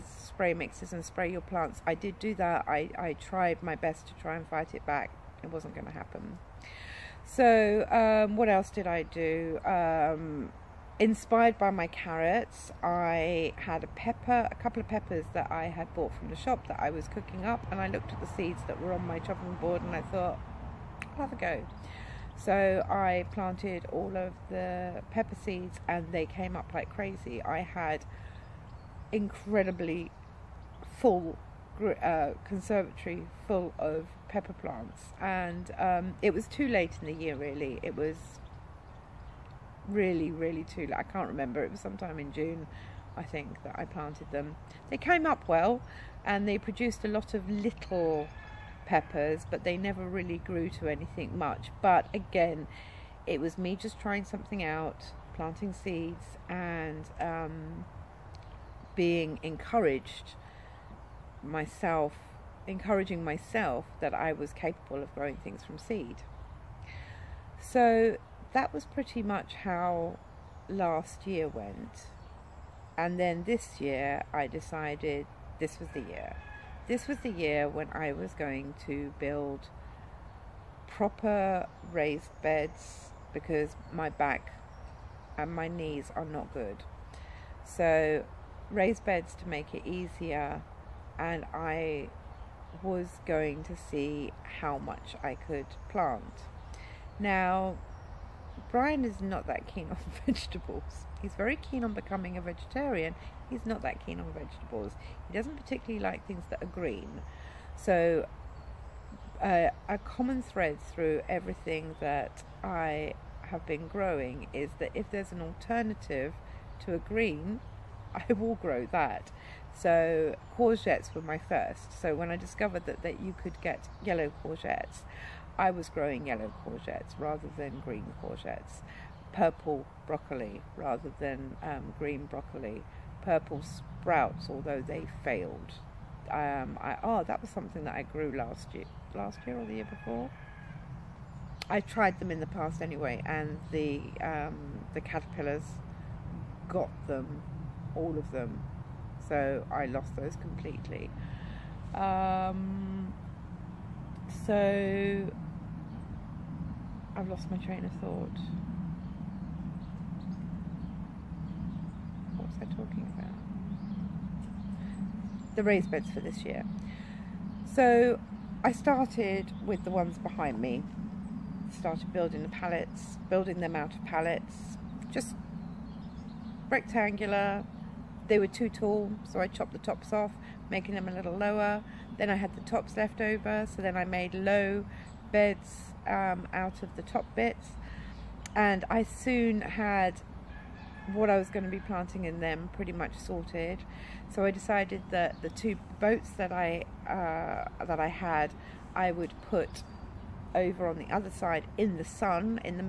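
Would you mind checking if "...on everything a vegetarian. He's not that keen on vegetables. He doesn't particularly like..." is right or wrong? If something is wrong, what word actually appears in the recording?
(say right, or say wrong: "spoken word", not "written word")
wrong: "becoming", not "everything".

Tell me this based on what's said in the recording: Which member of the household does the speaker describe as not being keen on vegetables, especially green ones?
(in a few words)
Brian.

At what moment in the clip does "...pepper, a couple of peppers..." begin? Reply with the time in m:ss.
0:13.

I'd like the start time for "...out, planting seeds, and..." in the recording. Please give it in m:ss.
0:54.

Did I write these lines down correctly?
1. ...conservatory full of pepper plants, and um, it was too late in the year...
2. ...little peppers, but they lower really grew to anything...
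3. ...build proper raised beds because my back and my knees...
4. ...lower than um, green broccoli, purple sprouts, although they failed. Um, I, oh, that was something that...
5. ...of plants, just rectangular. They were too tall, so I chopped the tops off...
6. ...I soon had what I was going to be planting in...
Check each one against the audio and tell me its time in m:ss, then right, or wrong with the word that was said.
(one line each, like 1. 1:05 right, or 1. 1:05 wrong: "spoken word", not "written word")
1. 0:32 right
2. 0:47 wrong: "never", not "lower"
3. 1:19 right
4. 2:10 wrong: "rather", not "lower"
5. 2:53 wrong: "pallets", not "plants"
6. 3:08 right.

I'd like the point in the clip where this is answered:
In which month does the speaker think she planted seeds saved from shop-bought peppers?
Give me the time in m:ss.
0:42.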